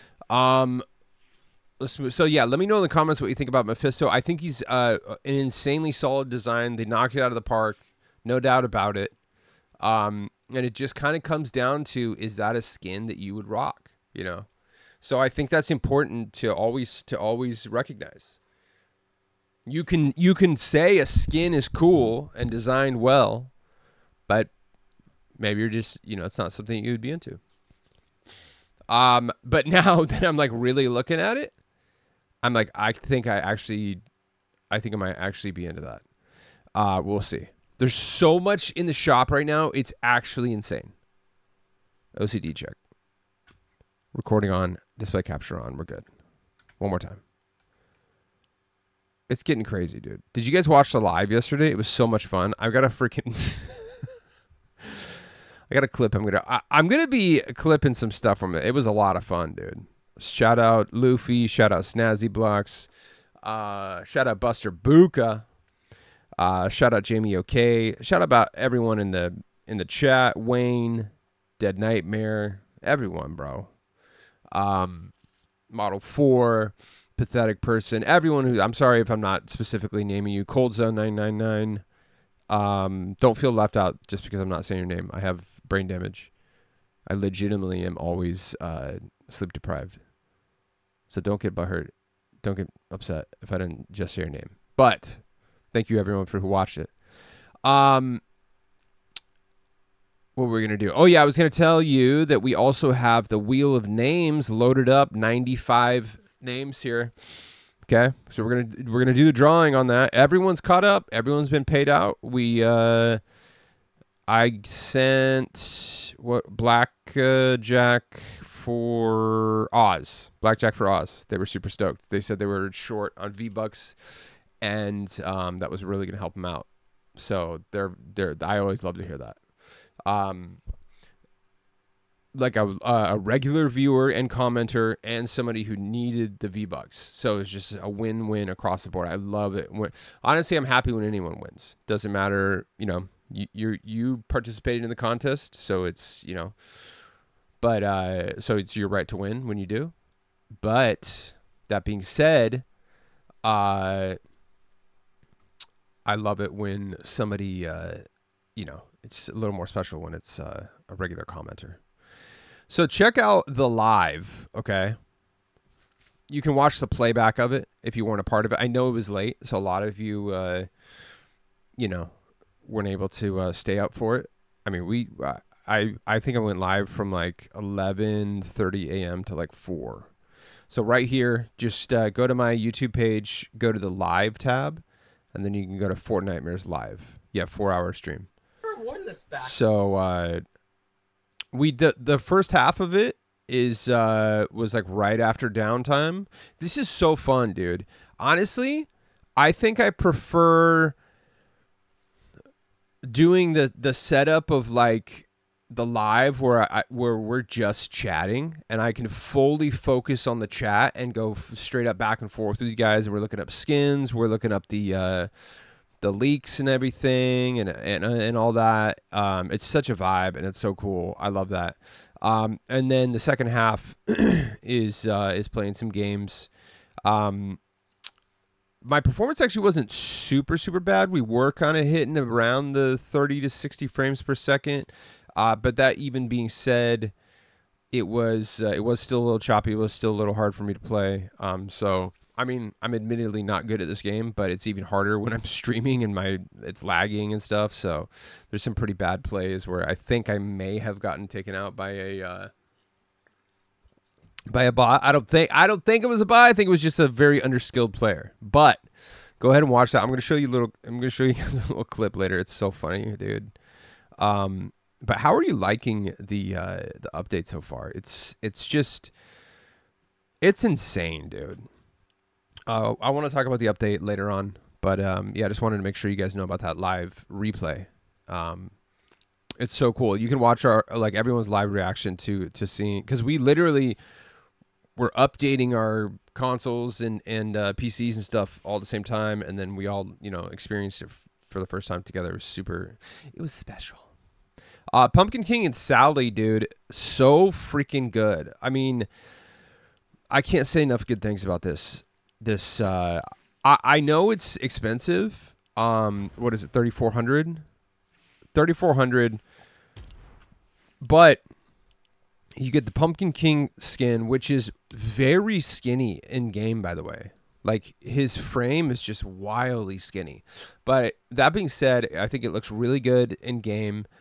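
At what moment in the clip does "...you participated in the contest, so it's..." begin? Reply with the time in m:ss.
2:23.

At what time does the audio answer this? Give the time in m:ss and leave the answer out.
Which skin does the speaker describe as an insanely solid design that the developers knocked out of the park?
0:03.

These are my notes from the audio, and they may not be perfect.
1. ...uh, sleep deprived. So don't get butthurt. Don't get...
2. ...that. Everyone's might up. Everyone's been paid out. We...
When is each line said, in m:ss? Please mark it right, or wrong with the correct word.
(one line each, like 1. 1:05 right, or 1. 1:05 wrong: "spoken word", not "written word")
1. 1:28 right
2. 1:49 wrong: "caught", not "might".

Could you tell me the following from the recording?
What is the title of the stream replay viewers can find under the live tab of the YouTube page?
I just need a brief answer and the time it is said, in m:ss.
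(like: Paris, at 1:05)
Fortnite Nightmares Live, at 3:05.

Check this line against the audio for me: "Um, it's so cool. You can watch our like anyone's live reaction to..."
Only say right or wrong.
wrong.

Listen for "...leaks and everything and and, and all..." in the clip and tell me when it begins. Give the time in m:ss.
3:36.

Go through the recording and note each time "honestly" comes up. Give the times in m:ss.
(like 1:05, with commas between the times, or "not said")
2:20, 3:18.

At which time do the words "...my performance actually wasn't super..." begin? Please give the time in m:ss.
3:48.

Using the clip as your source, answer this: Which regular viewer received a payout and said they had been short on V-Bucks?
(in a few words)
Blackjack for Oz.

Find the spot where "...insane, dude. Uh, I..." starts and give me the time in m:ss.
4:30.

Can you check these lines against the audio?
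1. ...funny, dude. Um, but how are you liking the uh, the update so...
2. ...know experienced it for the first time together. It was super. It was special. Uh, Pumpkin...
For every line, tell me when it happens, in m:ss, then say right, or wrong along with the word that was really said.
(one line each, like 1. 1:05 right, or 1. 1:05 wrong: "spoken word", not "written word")
1. 4:22 right
2. 4:50 right.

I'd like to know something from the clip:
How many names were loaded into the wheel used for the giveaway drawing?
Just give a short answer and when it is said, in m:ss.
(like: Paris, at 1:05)
95, at 1:45.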